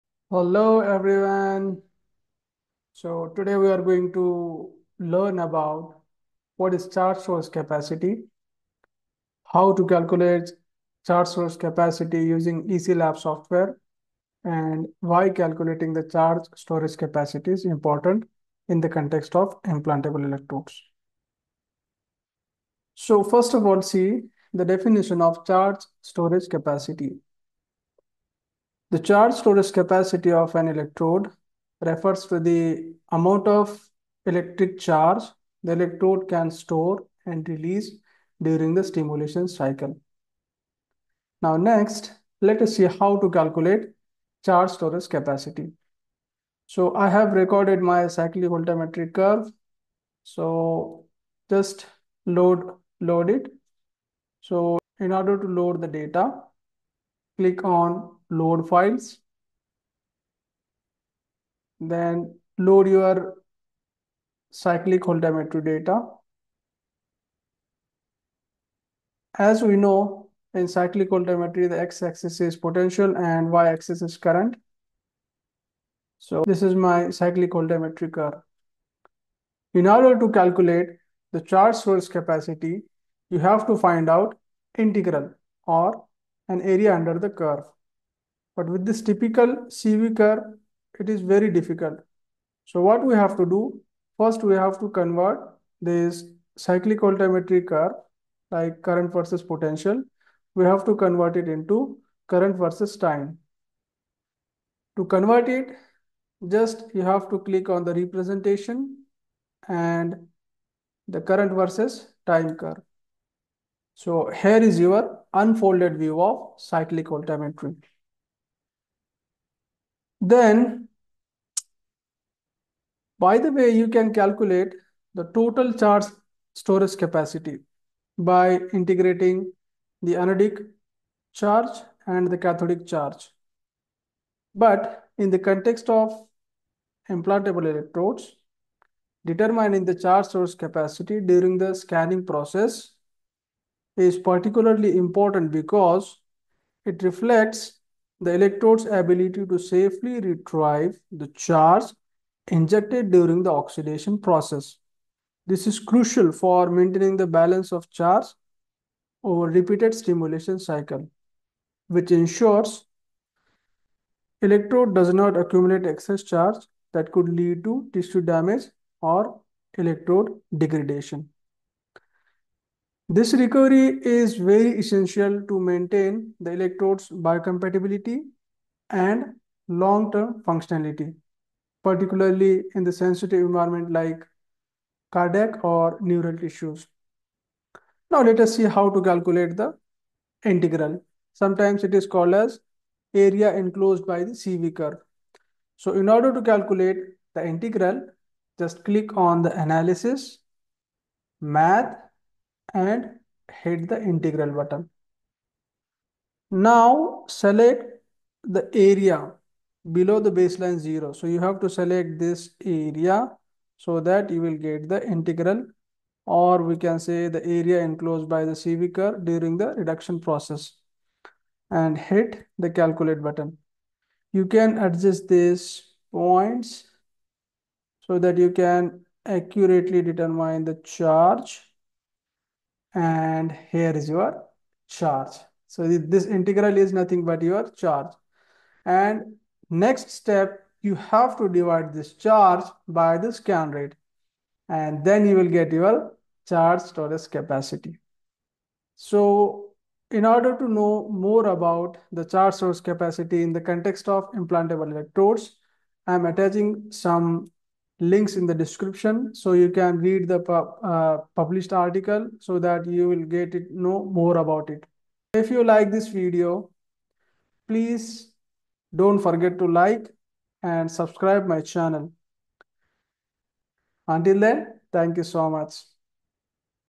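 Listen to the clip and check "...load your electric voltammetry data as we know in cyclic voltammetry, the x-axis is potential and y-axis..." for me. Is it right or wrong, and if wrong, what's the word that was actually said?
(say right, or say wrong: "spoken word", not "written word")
wrong: "cyclic", not "electric".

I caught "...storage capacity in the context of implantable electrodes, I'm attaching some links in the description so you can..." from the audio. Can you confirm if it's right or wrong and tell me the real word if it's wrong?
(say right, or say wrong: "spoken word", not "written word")
right.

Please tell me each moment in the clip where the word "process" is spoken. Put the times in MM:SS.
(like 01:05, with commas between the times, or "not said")
02:22, 02:34, 03:40.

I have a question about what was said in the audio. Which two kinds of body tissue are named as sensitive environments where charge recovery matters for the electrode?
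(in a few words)
Cardiac or neural.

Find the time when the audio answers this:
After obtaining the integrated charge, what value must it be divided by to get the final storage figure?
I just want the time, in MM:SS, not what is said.
04:03.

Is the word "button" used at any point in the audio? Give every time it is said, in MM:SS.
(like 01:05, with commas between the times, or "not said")
03:24, 03:43.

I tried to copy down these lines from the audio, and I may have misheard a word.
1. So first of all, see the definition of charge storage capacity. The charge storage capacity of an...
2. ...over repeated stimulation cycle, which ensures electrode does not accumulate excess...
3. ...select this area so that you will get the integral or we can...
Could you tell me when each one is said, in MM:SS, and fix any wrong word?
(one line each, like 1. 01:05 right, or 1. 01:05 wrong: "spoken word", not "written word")
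1. 00:22 right
2. 02:39 right
3. 03:31 right.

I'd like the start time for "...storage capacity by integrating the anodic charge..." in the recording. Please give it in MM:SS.
02:06.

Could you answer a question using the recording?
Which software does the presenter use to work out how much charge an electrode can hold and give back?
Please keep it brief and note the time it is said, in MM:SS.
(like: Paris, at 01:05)
EC Lab, at 00:12.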